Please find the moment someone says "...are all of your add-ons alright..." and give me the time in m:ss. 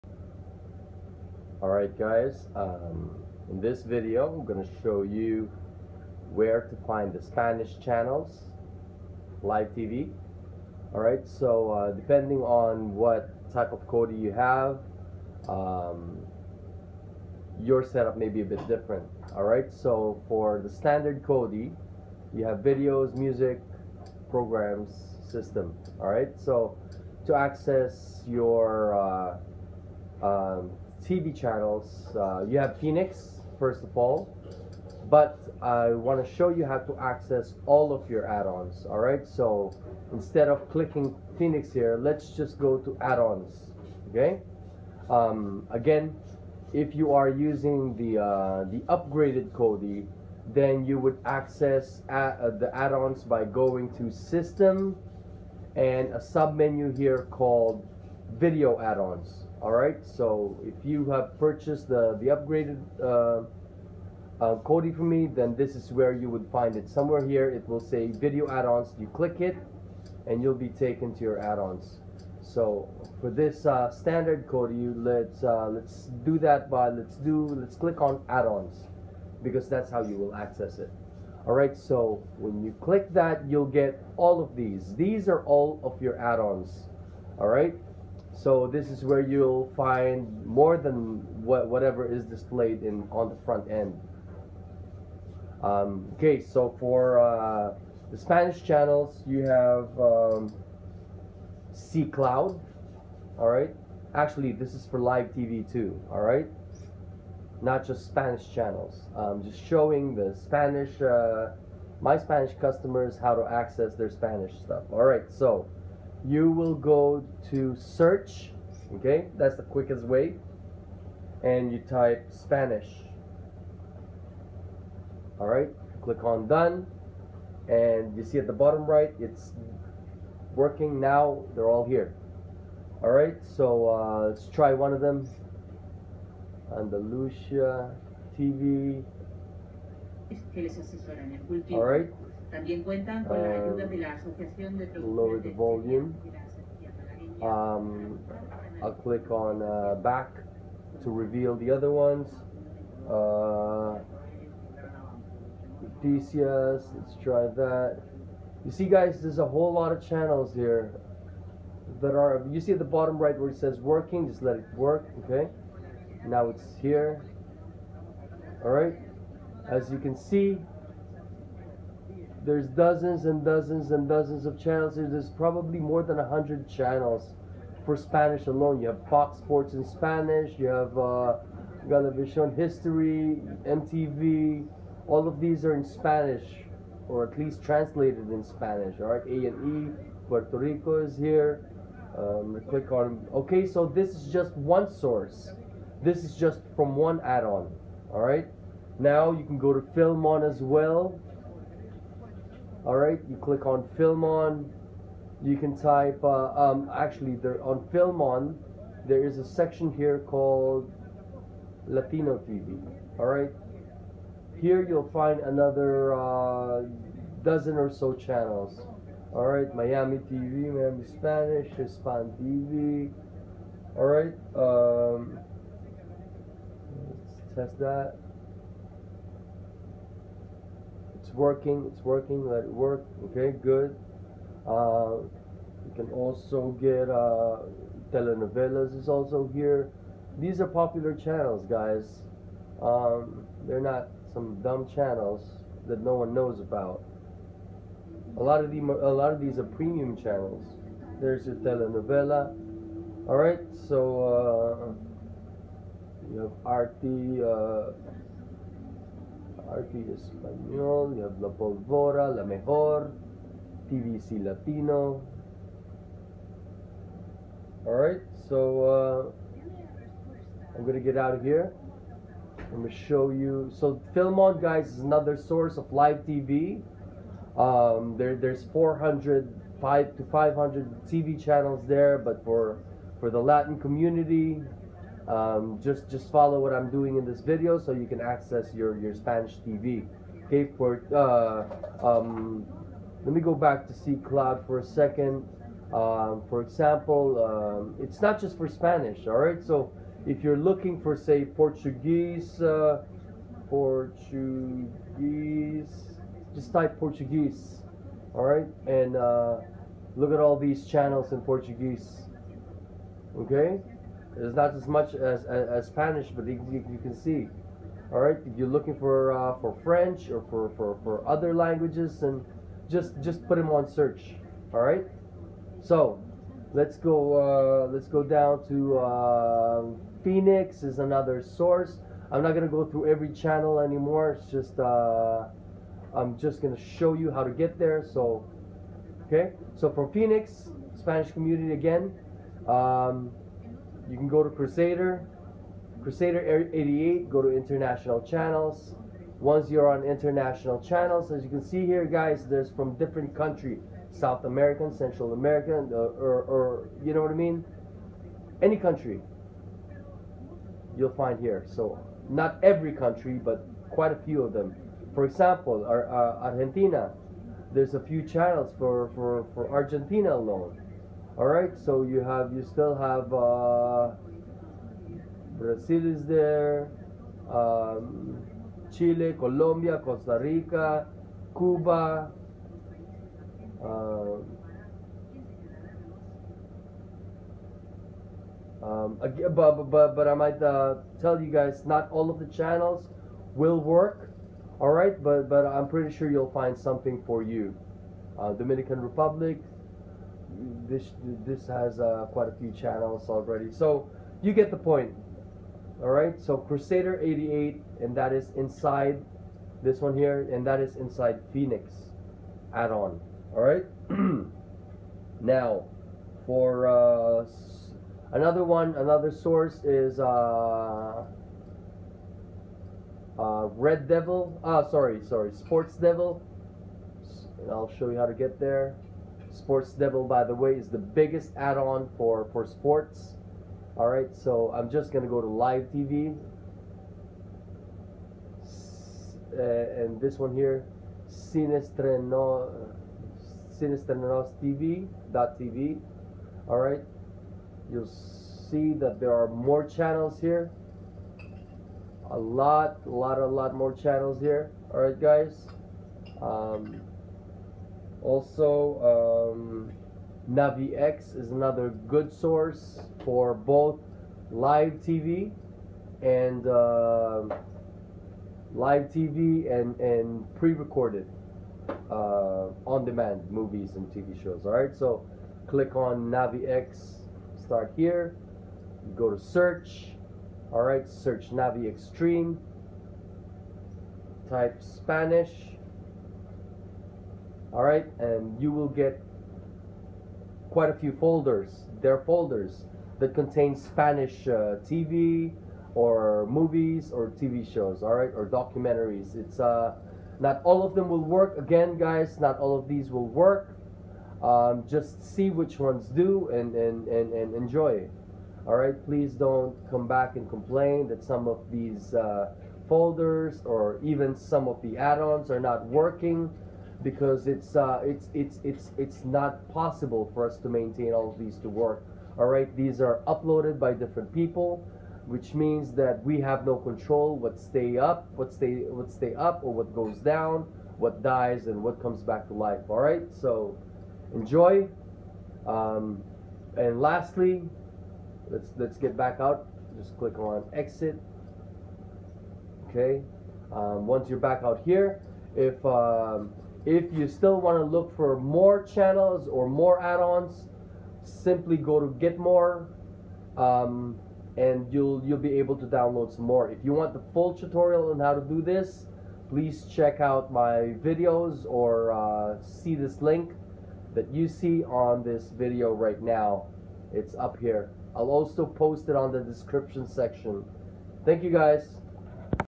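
1:25.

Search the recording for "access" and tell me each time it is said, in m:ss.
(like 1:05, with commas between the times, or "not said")
0:27, 0:36, 0:51, 1:20, 1:53, 4:48.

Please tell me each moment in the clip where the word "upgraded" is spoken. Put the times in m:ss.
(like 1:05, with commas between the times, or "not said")
0:48, 1:02.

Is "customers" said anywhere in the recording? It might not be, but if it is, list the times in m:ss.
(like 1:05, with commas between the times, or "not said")
1:52.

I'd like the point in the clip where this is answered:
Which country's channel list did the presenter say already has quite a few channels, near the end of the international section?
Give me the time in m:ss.
6:38.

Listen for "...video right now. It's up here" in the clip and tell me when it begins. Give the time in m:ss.
9:25.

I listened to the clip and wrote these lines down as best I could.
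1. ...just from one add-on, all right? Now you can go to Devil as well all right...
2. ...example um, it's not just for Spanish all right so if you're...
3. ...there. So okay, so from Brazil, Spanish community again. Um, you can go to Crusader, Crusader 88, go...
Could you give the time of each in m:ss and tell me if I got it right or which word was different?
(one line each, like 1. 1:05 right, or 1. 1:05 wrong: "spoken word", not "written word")
1. 3:16 wrong: "FilmOn", not "Devil"
2. 4:56 right
3. 5:37 wrong: "Phoenix", not "Brazil".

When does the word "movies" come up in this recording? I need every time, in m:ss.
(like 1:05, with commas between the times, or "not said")
7:53, 8:16.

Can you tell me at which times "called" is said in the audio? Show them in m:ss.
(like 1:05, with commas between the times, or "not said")
0:57, 3:30.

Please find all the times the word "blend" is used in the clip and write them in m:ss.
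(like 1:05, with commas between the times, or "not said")
not said.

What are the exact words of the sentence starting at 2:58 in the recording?
You have Fox Sports in Spanish, you have uh, Galavision History, MTV.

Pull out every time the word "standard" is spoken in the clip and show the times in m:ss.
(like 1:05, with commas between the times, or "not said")
0:20, 1:13.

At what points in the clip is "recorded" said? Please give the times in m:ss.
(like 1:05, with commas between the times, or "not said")
7:50.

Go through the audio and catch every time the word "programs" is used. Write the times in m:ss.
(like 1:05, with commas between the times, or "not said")
0:24.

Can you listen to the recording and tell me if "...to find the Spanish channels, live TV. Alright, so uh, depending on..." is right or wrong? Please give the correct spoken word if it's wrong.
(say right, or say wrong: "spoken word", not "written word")
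right.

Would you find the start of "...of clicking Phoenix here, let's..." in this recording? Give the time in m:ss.
0:40.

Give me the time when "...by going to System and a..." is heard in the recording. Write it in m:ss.
0:53.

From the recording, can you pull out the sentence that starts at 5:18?
All right, if you're looking for uh, for French or for, for, for other languages, and just just put them on search.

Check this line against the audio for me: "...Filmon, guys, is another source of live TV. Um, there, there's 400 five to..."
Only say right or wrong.
right.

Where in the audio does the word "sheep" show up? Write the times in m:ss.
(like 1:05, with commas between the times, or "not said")
not said.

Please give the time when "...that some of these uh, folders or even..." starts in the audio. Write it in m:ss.
8:31.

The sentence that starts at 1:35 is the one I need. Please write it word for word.
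Um, okay, so for uh, the Spanish channels, you have um, C Cloud.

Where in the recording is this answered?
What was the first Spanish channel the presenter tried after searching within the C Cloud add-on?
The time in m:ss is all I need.
2:16.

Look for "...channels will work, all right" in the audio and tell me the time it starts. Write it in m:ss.
6:32.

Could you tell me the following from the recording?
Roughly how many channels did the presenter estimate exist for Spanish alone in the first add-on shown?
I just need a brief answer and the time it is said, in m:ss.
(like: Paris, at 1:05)
more than 100, at 2:55.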